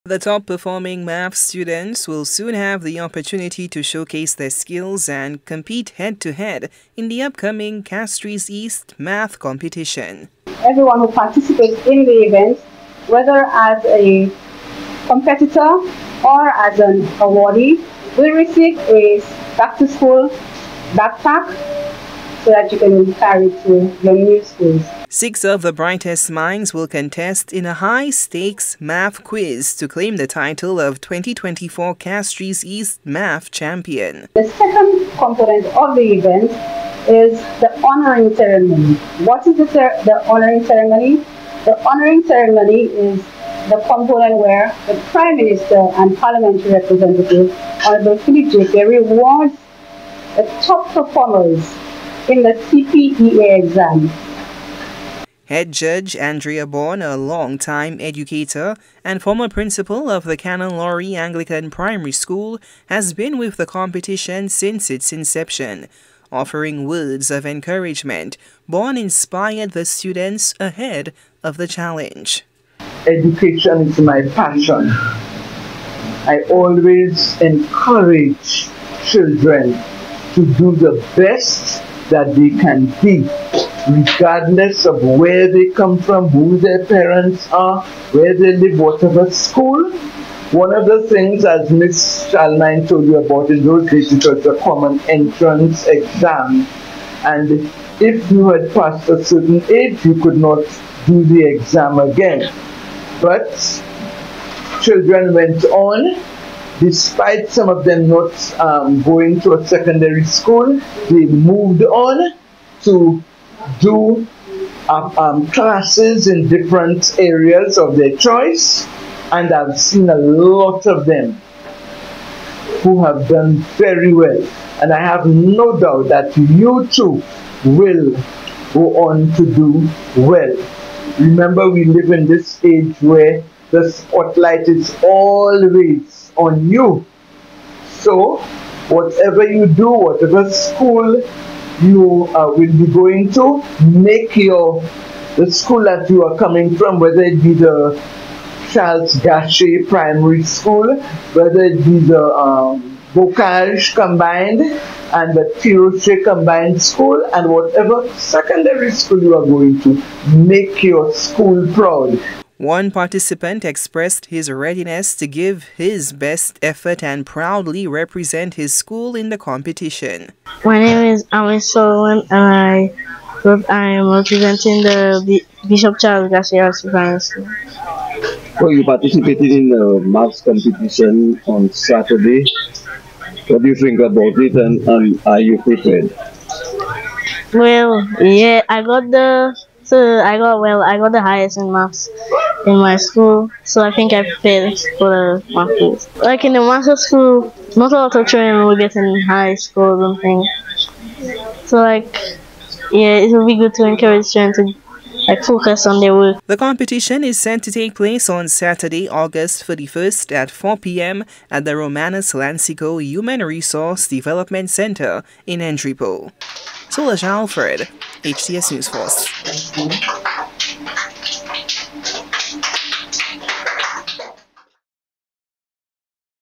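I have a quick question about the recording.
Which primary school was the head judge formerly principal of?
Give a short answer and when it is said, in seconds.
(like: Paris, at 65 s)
Canon Laurie Anglican Primary School, at 60 s.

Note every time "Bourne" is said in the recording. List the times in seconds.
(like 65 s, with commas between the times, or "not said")
56 s, 68 s.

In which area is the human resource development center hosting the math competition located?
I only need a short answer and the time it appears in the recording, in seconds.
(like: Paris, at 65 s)
Entrepot, at 215 s.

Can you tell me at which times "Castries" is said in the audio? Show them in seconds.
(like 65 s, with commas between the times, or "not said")
7 s, 31 s.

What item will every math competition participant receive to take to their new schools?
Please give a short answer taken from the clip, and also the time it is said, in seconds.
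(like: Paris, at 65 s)
back to school backpack, at 19 s.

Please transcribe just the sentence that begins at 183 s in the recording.
What do you think about it and, and are you prepared?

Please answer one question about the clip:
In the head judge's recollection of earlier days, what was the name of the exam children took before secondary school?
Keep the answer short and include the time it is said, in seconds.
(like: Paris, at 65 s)
common entrance exam, at 94 s.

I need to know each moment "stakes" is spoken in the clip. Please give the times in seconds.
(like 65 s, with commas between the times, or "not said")
27 s.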